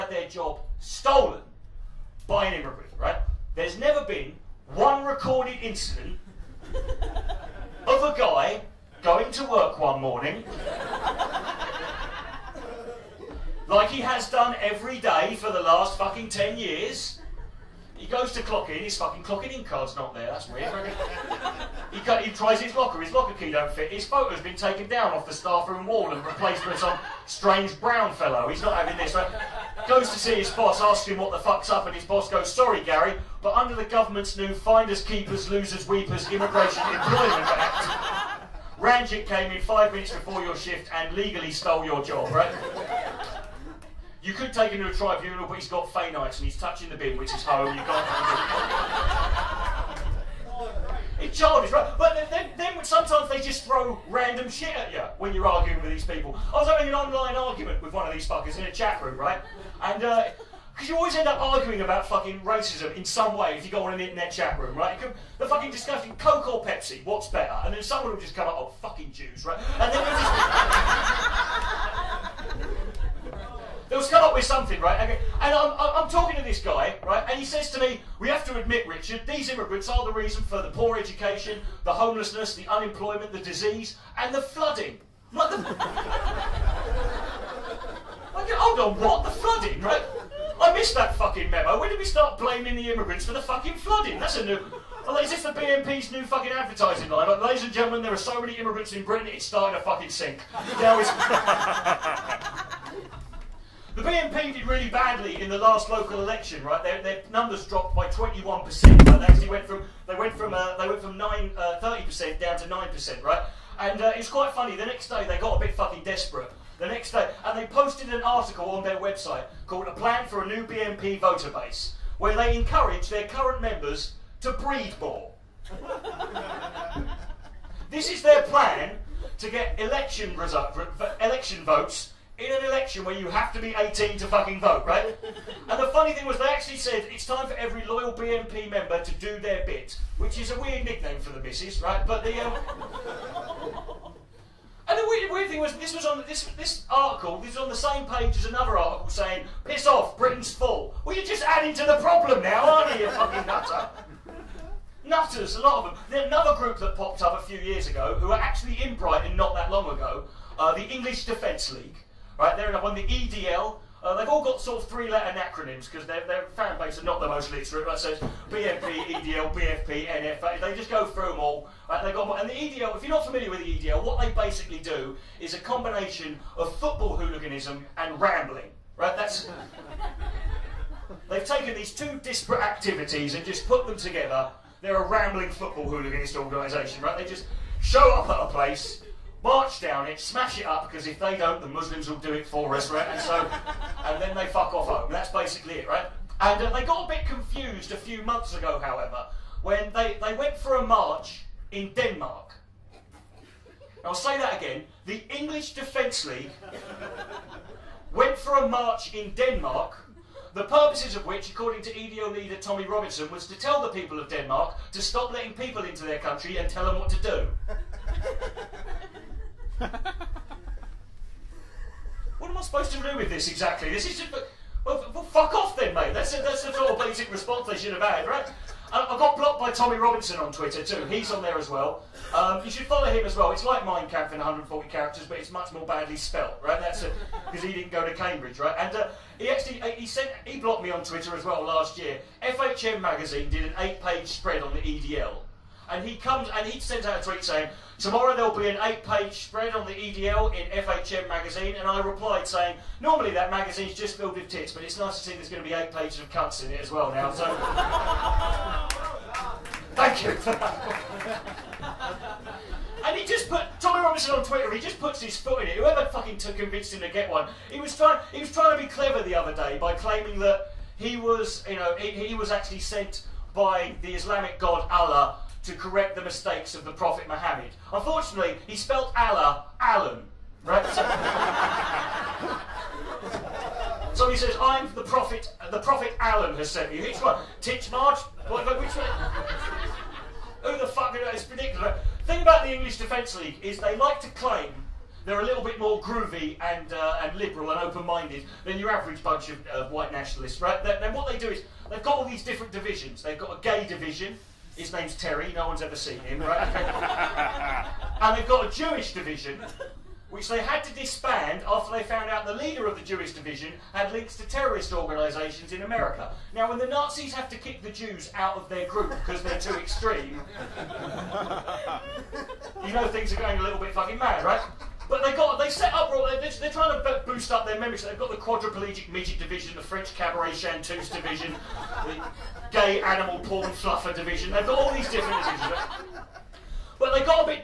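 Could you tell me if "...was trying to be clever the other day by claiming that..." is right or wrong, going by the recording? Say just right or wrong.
right.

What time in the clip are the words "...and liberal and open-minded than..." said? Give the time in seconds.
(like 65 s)
297 s.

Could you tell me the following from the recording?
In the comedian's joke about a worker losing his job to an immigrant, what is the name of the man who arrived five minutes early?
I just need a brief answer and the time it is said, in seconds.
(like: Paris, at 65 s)
Ranjit, at 38 s.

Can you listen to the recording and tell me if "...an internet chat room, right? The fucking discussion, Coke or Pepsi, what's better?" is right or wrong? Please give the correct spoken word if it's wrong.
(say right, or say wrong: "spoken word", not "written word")
right.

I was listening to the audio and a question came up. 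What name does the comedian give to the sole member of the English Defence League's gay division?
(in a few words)
Terry.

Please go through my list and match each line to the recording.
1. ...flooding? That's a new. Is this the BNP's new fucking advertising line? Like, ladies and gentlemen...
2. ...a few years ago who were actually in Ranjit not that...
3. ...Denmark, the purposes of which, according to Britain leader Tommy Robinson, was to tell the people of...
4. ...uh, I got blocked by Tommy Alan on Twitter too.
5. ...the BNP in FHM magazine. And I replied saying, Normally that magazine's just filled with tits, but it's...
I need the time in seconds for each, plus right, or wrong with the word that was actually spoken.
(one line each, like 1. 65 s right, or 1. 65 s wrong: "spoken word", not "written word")
1. 93 s right
2. 157 s wrong: "Brighton", not "Ranjit"
3. 209 s wrong: "EDL", not "Britain"
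4. 229 s wrong: "Robinson", not "Alan"
5. 249 s wrong: "EDL", not "BNP".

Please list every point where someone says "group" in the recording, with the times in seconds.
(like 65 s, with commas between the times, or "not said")
156 s, 318 s.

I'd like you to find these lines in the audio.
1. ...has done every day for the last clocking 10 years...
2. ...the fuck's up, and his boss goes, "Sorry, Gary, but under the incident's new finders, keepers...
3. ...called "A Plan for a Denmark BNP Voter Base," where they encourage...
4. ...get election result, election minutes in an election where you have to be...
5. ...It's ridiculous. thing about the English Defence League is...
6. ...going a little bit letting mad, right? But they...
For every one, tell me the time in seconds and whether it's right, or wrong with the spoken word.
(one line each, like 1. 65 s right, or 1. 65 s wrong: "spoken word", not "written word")
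1. 14 s wrong: "fucking", not "clocking"
2. 31 s wrong: "government", not "incident"
3. 119 s wrong: "New", not "Denmark"
4. 129 s wrong: "votes", not "minutes"
5. 291 s right
6. 323 s wrong: "fucking", not "letting".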